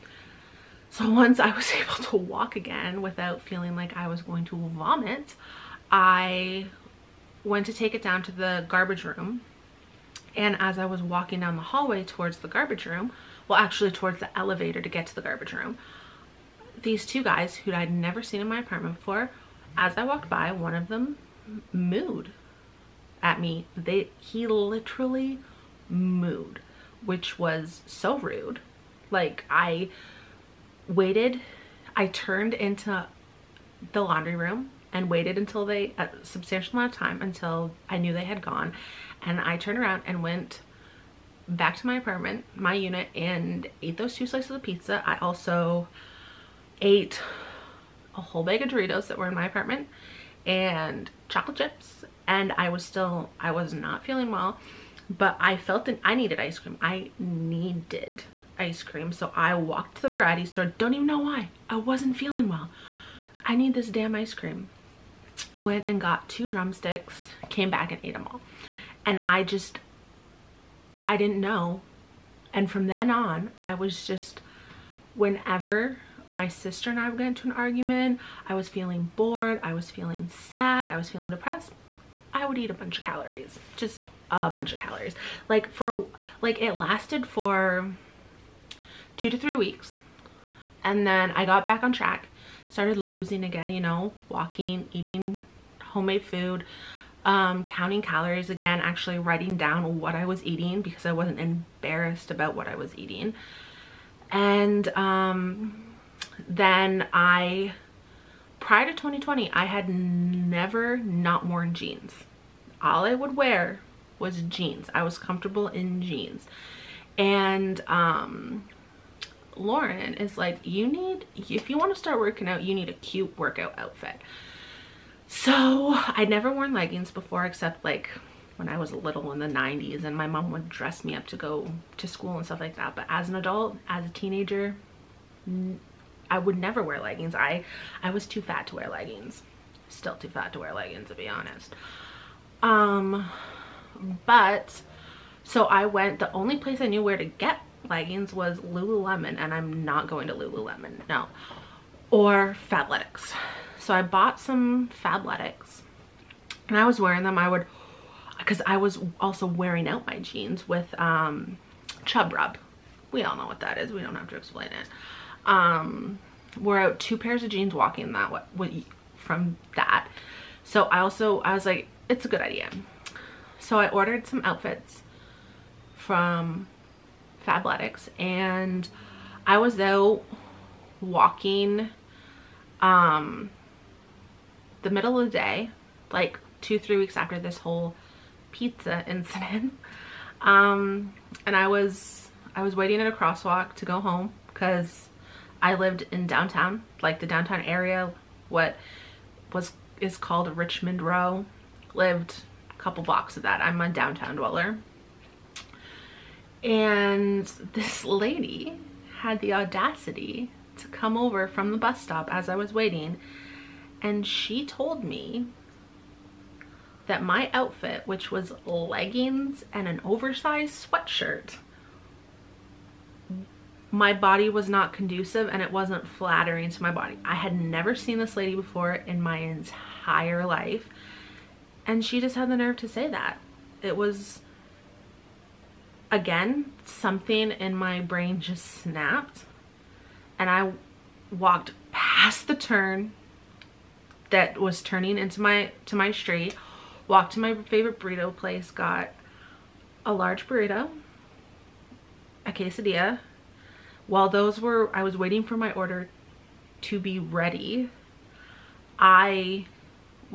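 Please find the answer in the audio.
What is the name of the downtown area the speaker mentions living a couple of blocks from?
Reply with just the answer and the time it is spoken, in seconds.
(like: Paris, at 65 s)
Richmond Row, at 200 s.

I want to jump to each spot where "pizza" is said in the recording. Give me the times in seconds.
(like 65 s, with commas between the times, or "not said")
44 s, 188 s.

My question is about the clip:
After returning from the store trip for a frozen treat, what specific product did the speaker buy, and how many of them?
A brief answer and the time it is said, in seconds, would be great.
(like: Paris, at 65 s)
2 drumsticks, at 66 s.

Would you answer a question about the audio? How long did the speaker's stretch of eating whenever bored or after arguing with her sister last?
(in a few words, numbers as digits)
2 to 3 weeks.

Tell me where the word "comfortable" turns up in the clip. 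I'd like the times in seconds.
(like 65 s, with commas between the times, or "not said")
115 s.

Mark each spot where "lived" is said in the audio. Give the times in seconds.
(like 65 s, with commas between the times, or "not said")
195 s, 201 s.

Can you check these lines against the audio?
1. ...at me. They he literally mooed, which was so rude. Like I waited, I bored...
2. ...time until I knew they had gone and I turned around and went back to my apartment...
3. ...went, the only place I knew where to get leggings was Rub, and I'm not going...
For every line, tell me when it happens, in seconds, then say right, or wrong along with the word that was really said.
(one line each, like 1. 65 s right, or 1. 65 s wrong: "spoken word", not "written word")
1. 23 s wrong: "turned", not "bored"
2. 36 s right
3. 145 s wrong: "Lululemon", not "Rub".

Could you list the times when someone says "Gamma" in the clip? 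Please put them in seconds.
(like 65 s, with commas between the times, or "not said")
not said.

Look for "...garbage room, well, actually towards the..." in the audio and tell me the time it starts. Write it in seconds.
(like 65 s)
12 s.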